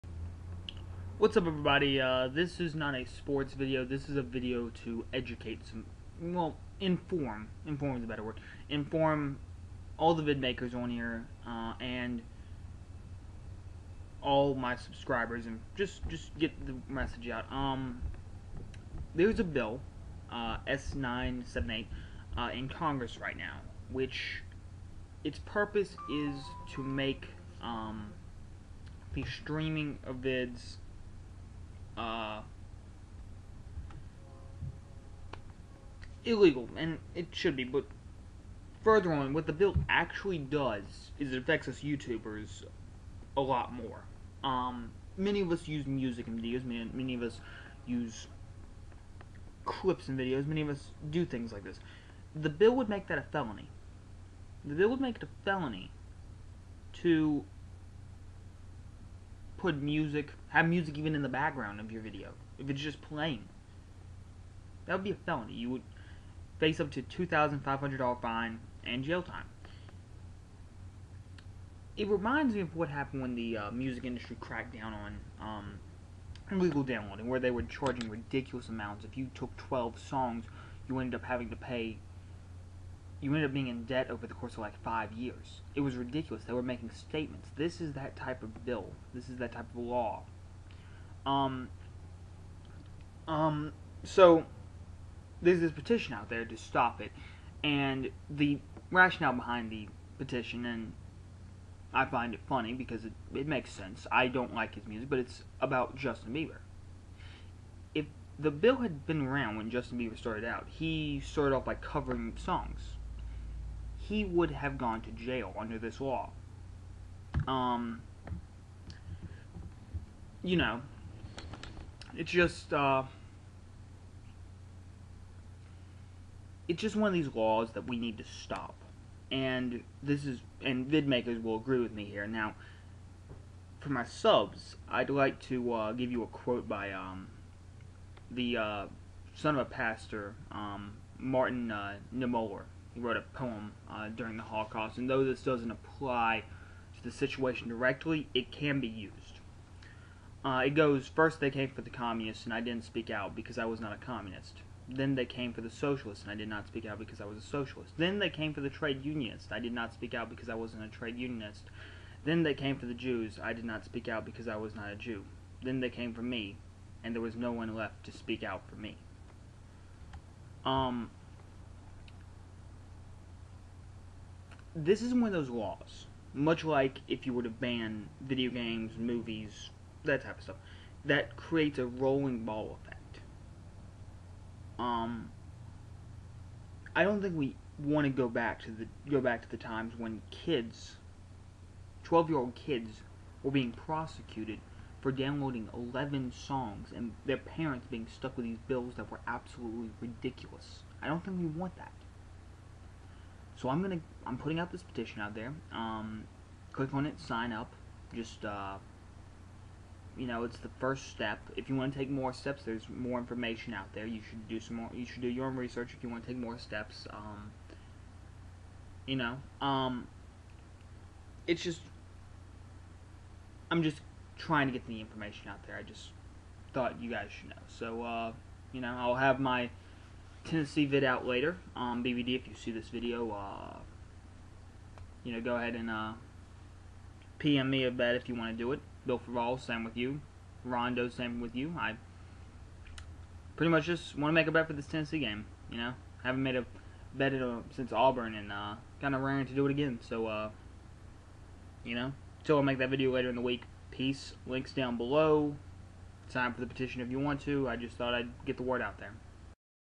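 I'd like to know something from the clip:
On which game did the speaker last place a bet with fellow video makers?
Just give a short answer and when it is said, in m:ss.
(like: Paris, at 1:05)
Auburn, at 4:07.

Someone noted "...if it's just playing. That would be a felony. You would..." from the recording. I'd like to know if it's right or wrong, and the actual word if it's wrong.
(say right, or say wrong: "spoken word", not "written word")
right.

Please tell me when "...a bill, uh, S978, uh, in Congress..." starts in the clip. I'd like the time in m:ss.
0:19.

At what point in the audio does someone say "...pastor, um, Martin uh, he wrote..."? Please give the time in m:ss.
2:19.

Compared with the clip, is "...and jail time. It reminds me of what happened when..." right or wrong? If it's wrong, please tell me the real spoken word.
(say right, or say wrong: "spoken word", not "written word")
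right.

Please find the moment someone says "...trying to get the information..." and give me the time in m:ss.
3:44.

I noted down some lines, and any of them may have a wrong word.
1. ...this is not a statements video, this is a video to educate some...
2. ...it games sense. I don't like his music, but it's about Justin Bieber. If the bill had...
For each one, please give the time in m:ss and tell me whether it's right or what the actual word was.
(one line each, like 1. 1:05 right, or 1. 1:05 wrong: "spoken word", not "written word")
1. 0:02 wrong: "sports", not "statements"
2. 1:43 wrong: "makes", not "games".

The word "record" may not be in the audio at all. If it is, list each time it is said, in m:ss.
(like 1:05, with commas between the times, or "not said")
not said.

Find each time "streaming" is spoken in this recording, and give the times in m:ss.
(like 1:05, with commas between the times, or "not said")
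0:29.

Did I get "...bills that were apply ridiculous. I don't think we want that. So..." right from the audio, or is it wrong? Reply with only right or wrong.
wrong.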